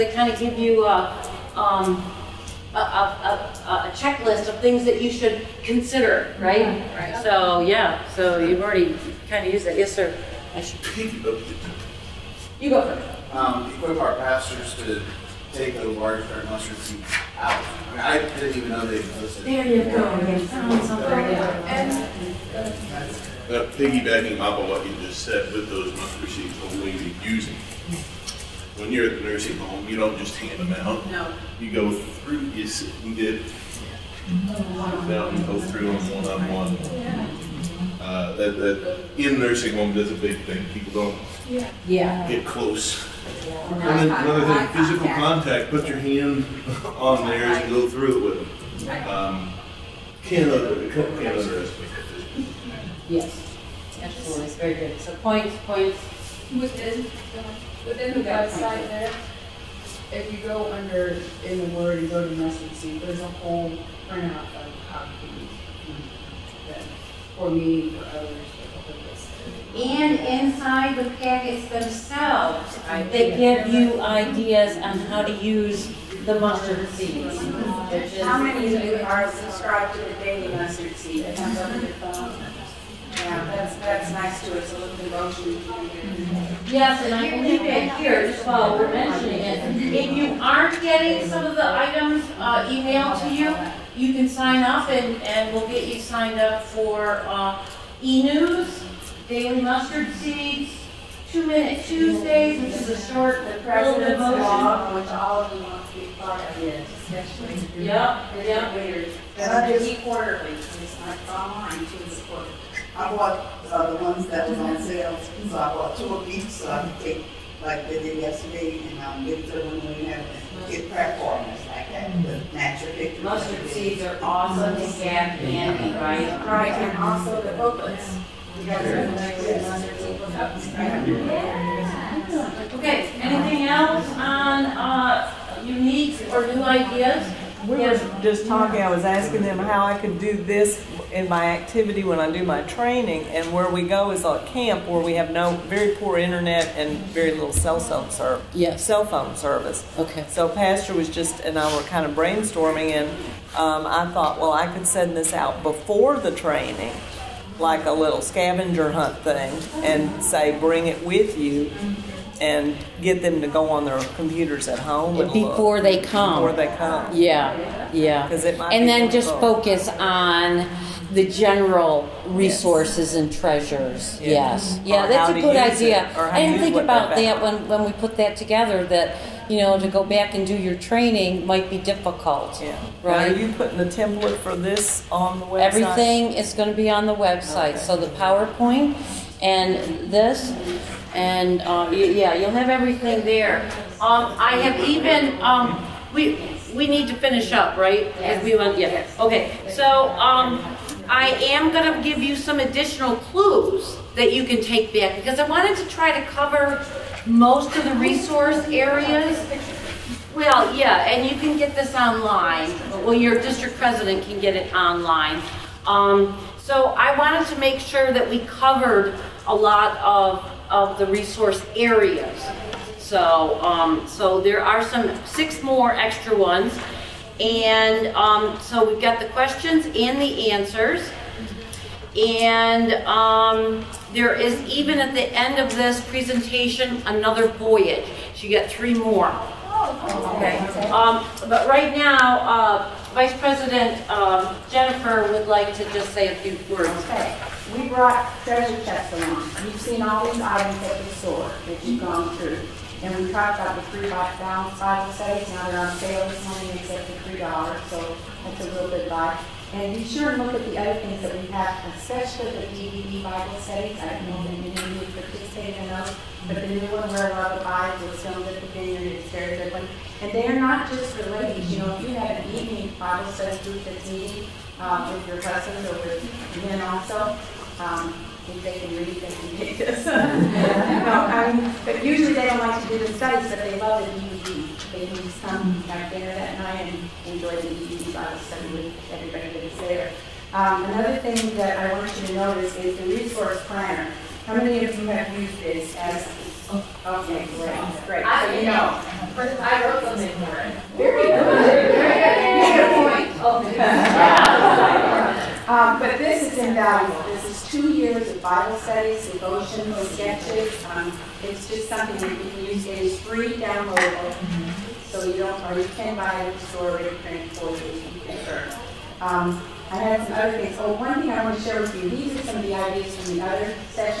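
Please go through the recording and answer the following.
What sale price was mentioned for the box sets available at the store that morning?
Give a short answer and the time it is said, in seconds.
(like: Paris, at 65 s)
3 dollars, at 257 s.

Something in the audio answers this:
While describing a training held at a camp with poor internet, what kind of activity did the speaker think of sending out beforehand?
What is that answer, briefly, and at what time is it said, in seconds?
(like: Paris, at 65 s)
scavenger hunt, at 158 s.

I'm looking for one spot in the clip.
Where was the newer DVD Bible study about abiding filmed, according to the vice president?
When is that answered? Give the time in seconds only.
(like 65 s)
268 s.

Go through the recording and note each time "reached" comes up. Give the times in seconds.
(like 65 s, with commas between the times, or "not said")
not said.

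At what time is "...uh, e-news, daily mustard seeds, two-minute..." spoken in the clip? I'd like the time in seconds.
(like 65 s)
97 s.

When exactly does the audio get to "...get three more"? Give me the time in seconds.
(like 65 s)
238 s.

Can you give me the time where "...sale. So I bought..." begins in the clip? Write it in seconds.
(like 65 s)
114 s.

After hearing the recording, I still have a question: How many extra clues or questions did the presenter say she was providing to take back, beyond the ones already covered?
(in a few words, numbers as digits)
6.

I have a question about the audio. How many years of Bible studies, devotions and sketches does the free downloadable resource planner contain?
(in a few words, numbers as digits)
2.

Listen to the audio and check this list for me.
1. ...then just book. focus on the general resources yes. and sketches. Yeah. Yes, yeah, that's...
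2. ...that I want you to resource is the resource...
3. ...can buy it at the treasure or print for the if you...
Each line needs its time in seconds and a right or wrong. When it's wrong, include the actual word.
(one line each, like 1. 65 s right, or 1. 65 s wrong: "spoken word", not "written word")
1. 168 s wrong: "treasures", not "sketches"
2. 291 s wrong: "notice", not "resource"
3. 315 s wrong: "store", not "treasure".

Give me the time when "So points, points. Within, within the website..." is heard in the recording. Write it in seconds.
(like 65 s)
54 s.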